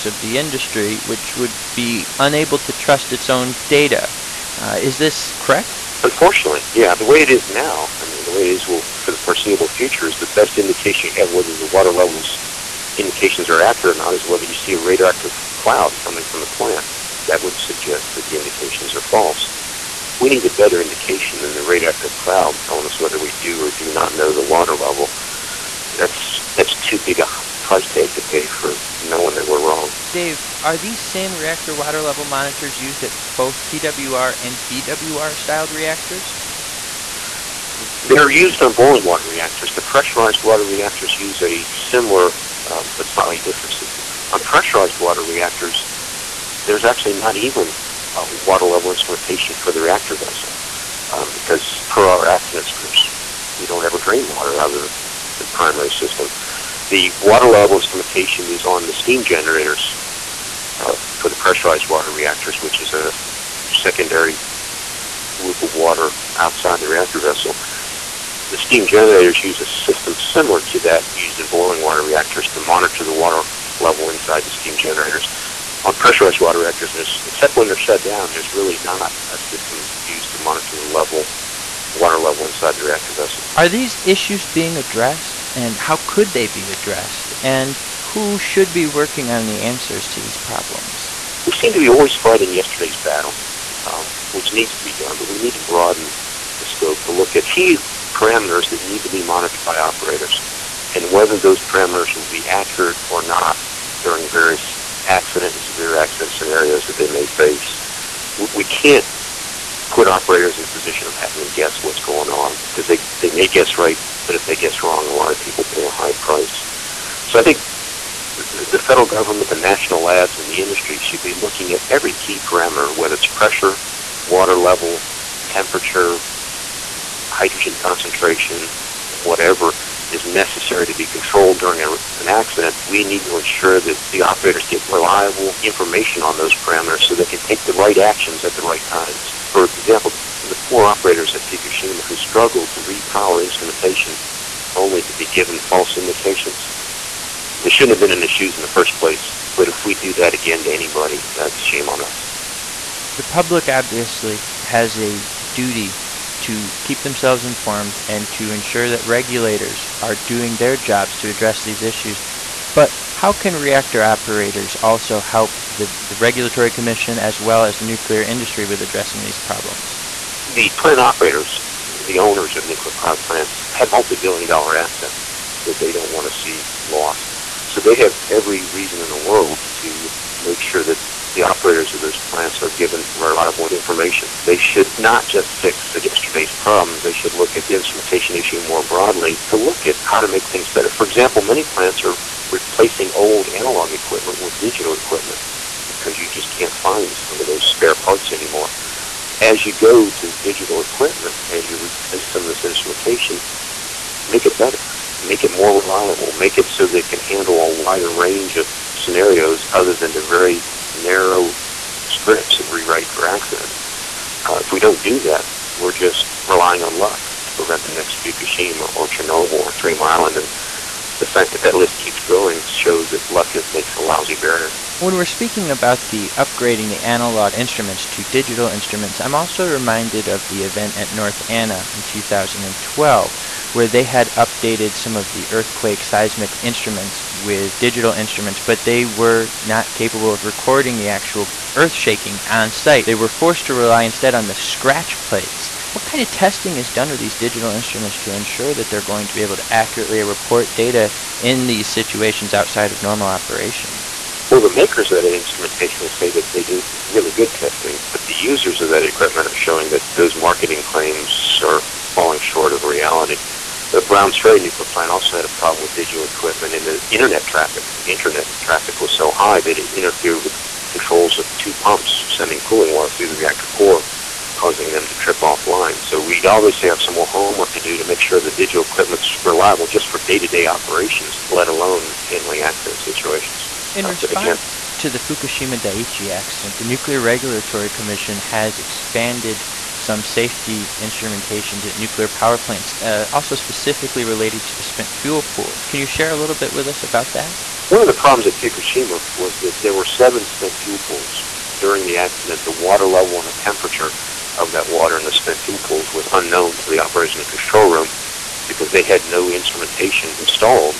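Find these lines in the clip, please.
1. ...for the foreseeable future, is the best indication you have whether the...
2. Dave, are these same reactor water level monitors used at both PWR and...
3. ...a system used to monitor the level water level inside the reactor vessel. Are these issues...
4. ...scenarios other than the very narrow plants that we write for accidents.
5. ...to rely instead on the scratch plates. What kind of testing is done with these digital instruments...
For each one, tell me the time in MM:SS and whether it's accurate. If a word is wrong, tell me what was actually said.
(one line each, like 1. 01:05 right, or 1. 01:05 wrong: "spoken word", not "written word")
1. 00:09 right
2. 00:30 right
3. 01:19 right
4. 03:28 wrong: "scripts", not "plants"
5. 04:03 right.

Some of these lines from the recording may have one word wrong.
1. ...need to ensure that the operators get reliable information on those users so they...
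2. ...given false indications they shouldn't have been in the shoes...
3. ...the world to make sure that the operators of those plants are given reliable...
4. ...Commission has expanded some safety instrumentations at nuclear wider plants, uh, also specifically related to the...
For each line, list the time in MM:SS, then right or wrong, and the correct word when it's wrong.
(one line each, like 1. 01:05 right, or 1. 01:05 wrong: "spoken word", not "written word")
1. 02:13 wrong: "parameters", not "users"
2. 02:25 right
3. 02:59 right
4. 04:47 wrong: "power", not "wider".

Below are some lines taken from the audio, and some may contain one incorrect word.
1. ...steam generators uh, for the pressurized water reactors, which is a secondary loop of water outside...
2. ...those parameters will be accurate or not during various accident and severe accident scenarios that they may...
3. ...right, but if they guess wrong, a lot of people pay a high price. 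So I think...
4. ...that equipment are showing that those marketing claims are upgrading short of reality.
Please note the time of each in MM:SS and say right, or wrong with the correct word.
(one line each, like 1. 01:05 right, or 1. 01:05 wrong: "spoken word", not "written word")
1. 00:58 right
2. 01:41 right
3. 01:53 right
4. 04:18 wrong: "falling", not "upgrading".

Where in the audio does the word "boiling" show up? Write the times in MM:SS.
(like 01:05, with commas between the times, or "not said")
00:38, 01:11.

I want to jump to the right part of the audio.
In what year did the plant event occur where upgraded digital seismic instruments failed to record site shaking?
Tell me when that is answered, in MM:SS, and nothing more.
03:52.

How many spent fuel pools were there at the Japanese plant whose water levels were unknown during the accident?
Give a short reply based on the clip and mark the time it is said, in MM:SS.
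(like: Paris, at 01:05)
7, at 05:00.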